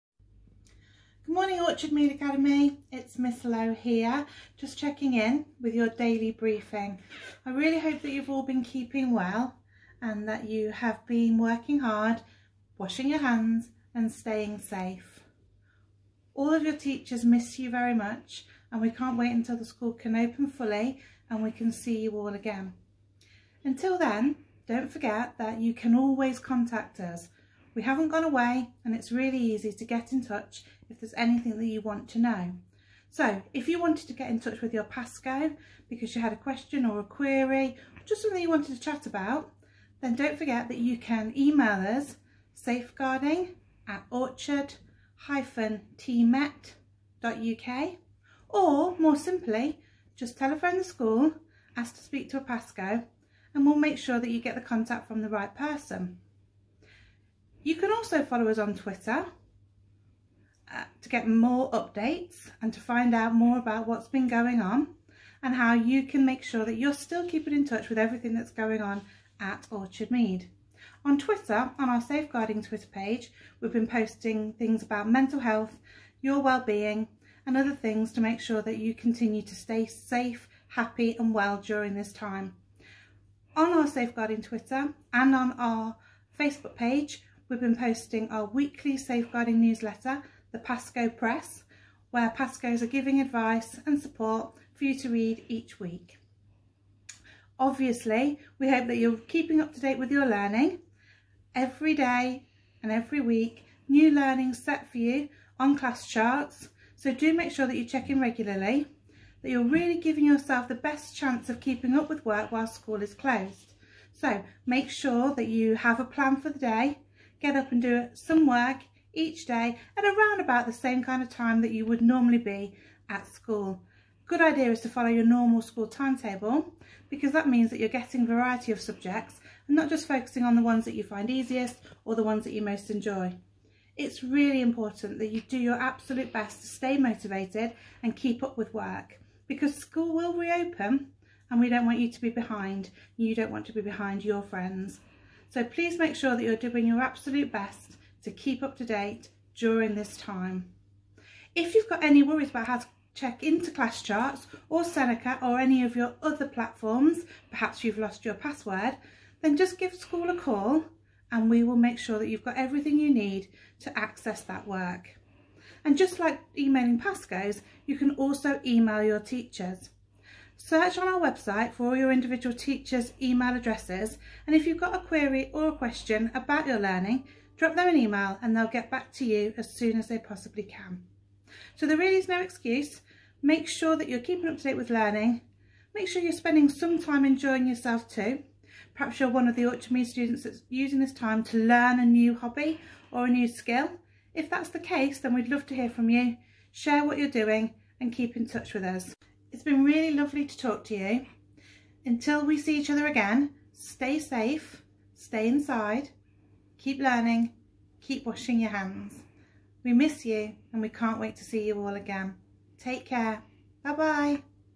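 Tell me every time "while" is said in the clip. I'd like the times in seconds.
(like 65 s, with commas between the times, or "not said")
112 s.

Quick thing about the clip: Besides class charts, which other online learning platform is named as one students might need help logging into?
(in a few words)
Seneca.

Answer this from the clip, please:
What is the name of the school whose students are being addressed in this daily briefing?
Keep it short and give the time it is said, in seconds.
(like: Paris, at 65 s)
Orchard Mead Academy, at 1 s.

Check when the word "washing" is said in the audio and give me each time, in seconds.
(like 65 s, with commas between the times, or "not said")
12 s, 208 s.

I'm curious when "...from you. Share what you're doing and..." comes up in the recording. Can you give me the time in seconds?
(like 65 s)
195 s.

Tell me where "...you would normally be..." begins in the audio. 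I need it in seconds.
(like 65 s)
121 s.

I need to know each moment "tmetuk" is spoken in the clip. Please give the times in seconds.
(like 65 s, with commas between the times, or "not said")
44 s.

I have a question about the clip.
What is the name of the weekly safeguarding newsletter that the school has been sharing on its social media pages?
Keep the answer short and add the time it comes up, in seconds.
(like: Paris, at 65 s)
Pasco Press, at 90 s.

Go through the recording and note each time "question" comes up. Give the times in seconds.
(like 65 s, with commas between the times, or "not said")
36 s, 175 s.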